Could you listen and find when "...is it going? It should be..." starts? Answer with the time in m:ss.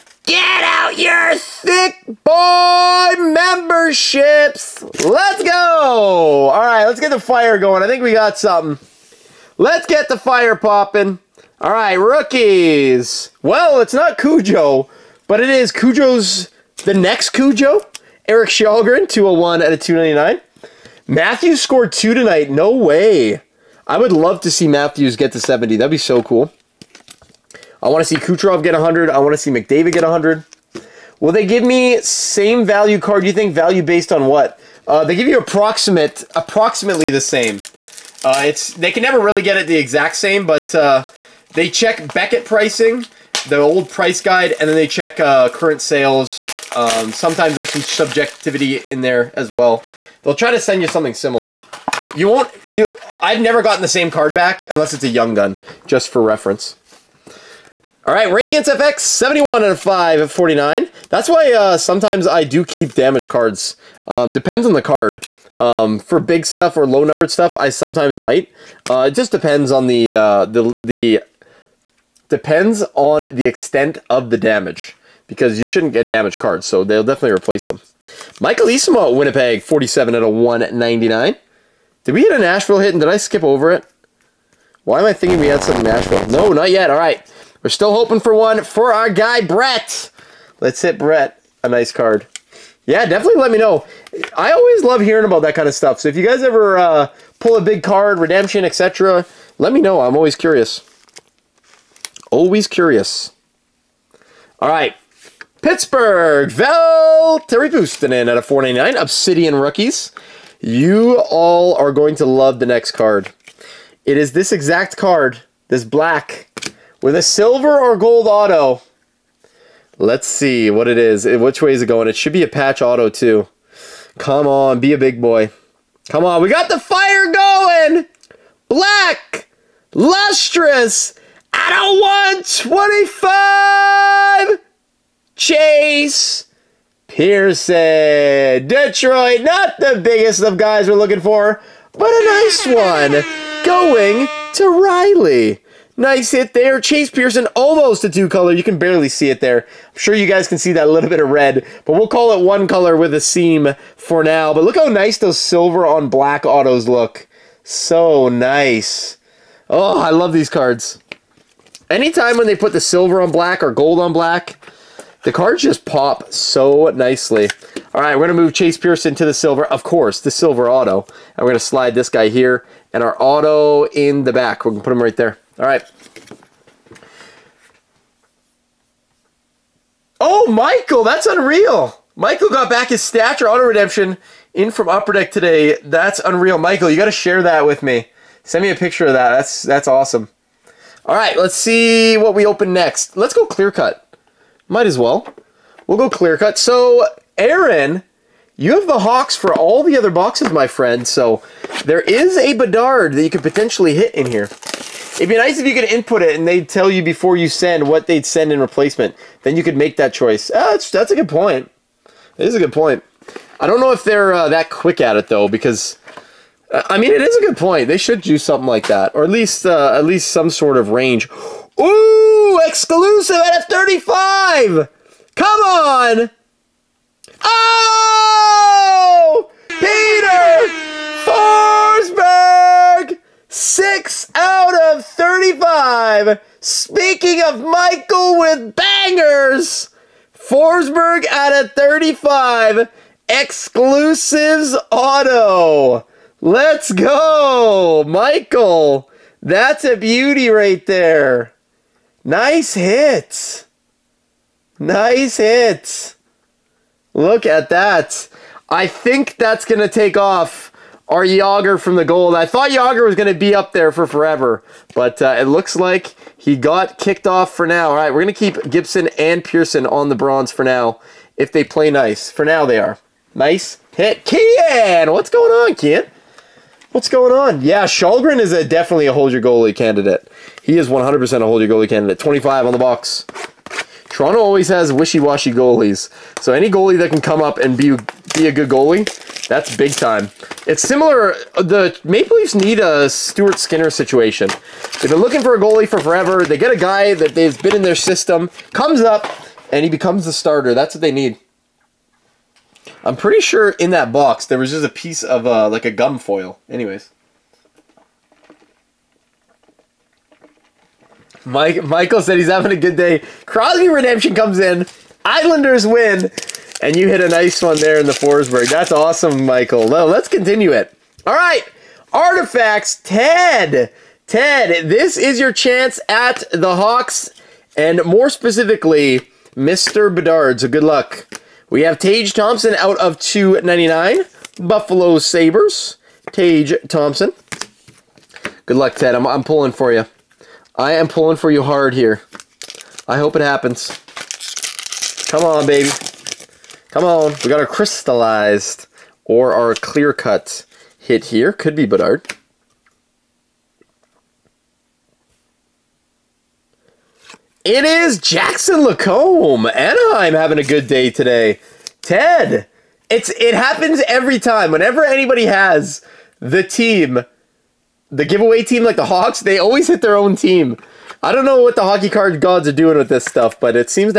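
2:01.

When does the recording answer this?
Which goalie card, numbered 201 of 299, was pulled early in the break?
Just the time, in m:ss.
0:18.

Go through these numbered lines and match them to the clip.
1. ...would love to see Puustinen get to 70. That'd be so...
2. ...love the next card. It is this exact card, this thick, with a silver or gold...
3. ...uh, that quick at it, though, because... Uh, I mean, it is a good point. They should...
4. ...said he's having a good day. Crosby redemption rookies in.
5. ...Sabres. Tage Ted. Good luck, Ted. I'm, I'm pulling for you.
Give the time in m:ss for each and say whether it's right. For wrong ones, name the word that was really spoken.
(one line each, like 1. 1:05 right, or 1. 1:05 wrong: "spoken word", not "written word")
1. 0:23 wrong: "Matthews", not "Puustinen"
2. 1:52 wrong: "black", not "thick"
3. 3:34 right
4. 5:12 wrong: "comes", not "rookies"
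5. 5:35 wrong: "Thompson", not "Ted".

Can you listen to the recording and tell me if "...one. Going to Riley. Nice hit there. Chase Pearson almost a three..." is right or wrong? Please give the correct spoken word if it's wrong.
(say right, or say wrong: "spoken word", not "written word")
wrong: "two", not "three".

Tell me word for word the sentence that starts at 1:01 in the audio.
That's why uh, sometimes I do keep damage cards.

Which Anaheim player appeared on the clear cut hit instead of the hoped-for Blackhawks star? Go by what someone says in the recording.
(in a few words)
Jackson Lacombe.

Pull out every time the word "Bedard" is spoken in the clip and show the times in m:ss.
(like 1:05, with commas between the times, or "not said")
3:22, 5:30, 5:51.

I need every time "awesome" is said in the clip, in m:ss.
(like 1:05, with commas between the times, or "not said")
3:09, 5:18.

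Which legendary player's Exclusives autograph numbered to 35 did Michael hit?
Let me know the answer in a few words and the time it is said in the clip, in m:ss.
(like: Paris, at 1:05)
Peter Forsberg, at 3:49.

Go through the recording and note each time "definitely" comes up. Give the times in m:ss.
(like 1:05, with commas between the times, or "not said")
1:17, 1:33, 4:38.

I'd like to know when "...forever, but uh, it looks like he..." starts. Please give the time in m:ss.
4:24.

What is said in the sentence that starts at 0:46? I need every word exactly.
Um, sometimes there's some subjectivity in there as well.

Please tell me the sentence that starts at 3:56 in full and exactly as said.
Speaking of Michael with bangers, Forsberg out of 35.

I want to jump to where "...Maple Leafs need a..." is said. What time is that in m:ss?
4:52.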